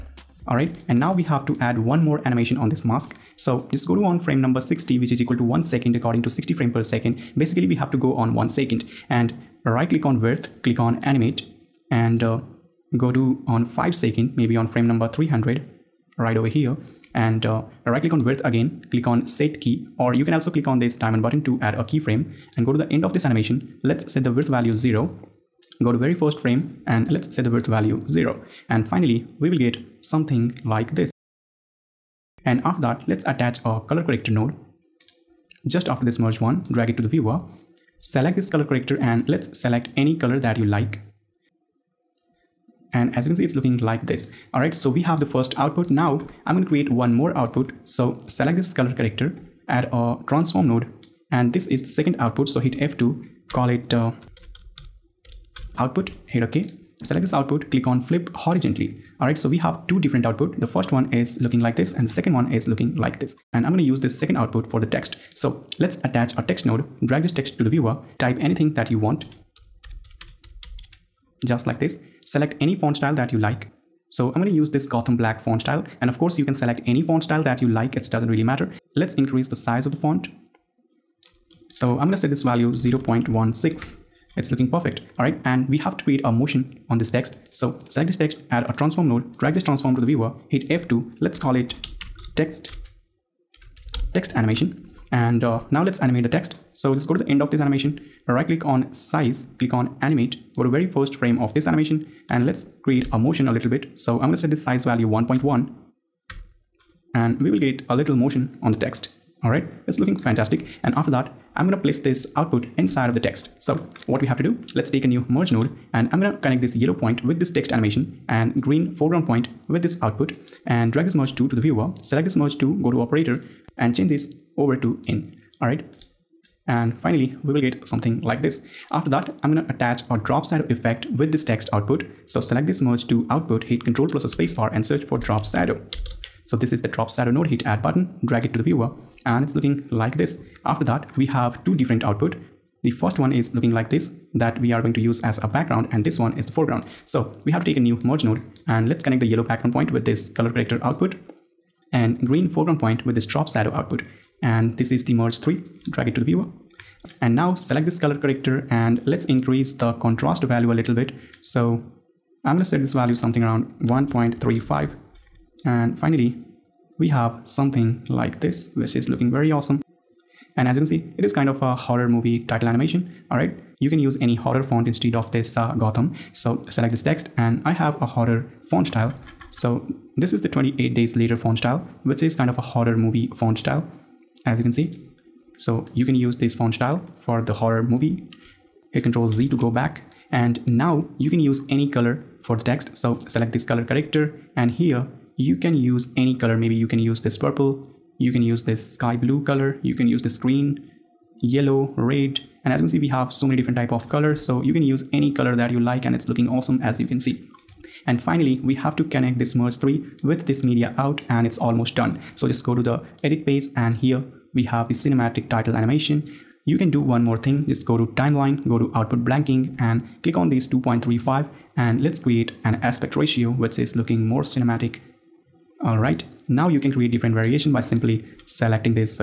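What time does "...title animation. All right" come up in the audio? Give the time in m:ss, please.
2:52.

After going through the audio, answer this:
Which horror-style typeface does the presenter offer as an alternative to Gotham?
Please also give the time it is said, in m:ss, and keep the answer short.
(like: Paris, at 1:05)
28 Days Later, at 3:00.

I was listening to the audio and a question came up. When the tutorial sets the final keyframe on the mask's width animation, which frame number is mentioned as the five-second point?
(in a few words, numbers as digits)
300.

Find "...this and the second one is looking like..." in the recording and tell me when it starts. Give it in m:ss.
1:01.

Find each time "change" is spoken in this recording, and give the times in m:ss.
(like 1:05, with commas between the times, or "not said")
2:03.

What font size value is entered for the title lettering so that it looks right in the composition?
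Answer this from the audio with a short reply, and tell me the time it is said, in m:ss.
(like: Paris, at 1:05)
0.16, at 1:22.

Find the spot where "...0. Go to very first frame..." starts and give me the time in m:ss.
0:24.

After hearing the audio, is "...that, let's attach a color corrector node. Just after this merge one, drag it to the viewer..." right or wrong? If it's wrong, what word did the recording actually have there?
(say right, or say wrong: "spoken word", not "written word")
right.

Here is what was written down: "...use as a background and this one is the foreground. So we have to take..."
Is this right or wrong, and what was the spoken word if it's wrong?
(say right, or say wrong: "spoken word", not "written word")
right.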